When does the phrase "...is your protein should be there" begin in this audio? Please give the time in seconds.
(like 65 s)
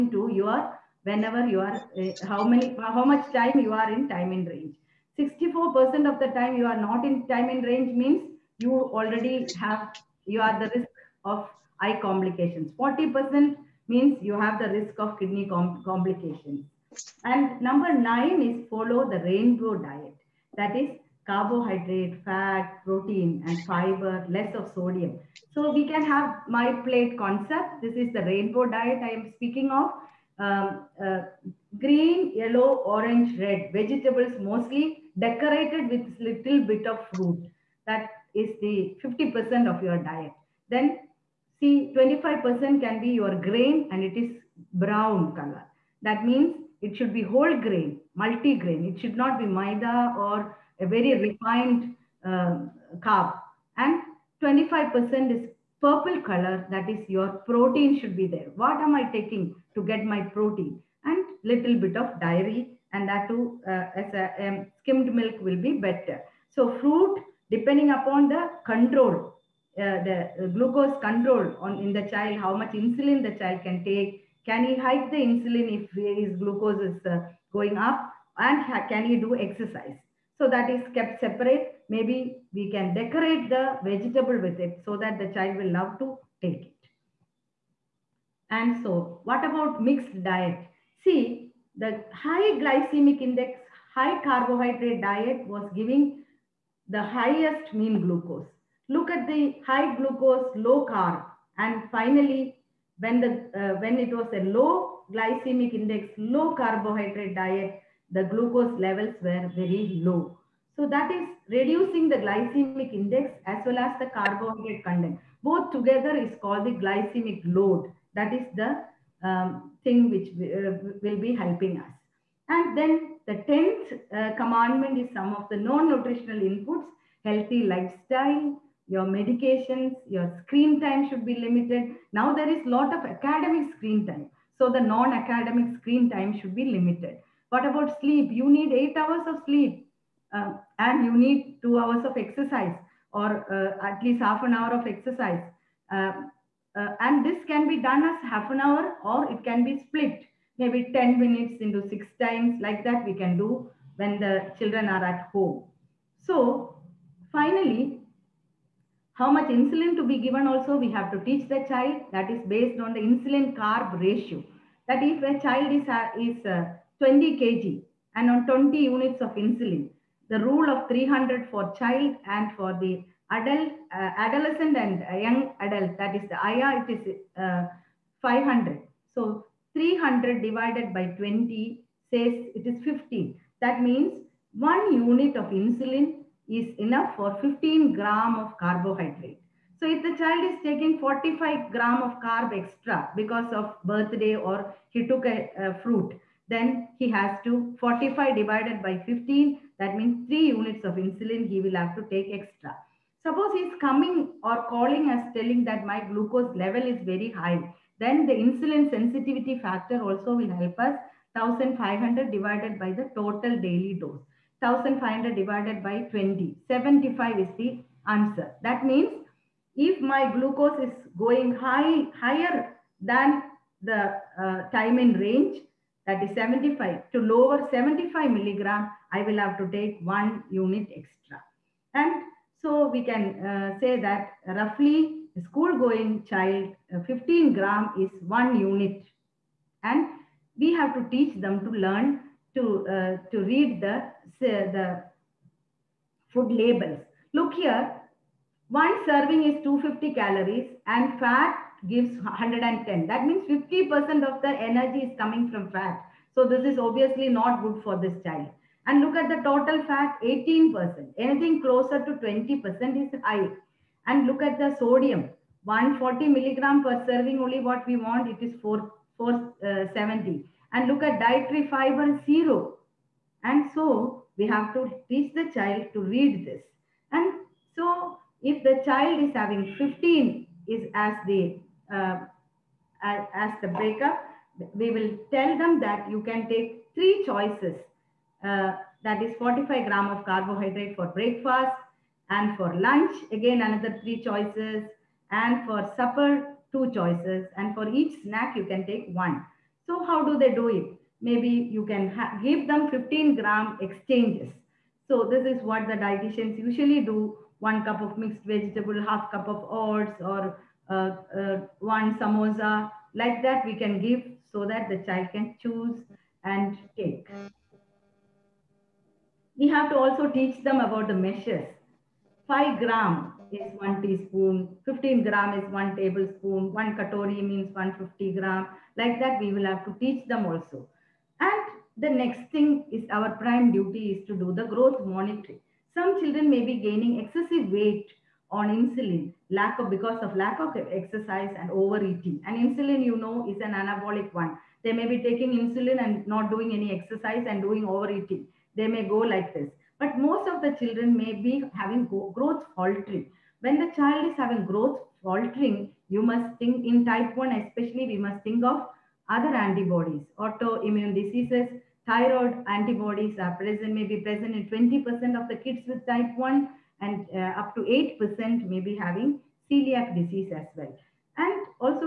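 56 s.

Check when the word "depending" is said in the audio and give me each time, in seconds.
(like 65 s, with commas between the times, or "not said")
67 s.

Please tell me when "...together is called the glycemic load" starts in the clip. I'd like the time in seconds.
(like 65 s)
115 s.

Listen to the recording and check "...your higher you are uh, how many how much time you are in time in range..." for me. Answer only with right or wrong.
wrong.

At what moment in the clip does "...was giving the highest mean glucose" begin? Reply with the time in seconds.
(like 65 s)
95 s.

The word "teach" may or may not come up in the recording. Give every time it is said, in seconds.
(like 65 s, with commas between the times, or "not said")
161 s, 241 s, 275 s, 320 s, 329 s.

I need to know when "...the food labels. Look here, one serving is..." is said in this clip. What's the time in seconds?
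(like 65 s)
244 s.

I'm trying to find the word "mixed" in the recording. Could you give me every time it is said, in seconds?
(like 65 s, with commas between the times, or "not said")
89 s, 308 s.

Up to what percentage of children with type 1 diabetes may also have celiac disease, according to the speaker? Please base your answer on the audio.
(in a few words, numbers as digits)
8%.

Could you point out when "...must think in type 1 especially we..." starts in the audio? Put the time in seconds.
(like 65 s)
356 s.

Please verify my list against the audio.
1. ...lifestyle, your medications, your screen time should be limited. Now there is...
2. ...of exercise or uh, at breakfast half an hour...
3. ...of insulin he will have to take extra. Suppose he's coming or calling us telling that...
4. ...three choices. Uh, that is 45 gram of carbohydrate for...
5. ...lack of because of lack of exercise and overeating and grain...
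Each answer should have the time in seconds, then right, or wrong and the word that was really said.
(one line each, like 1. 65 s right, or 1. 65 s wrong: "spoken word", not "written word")
1. 127 s right
2. 142 s wrong: "least", not "breakfast"
3. 200 s right
4. 286 s right
5. 339 s wrong: "insulin", not "grain".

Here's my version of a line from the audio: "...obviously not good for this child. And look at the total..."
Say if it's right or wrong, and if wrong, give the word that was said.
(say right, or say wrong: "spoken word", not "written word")
right.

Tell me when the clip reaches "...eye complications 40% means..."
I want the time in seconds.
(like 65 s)
11 s.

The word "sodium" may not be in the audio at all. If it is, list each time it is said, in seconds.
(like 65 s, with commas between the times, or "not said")
24 s, 264 s.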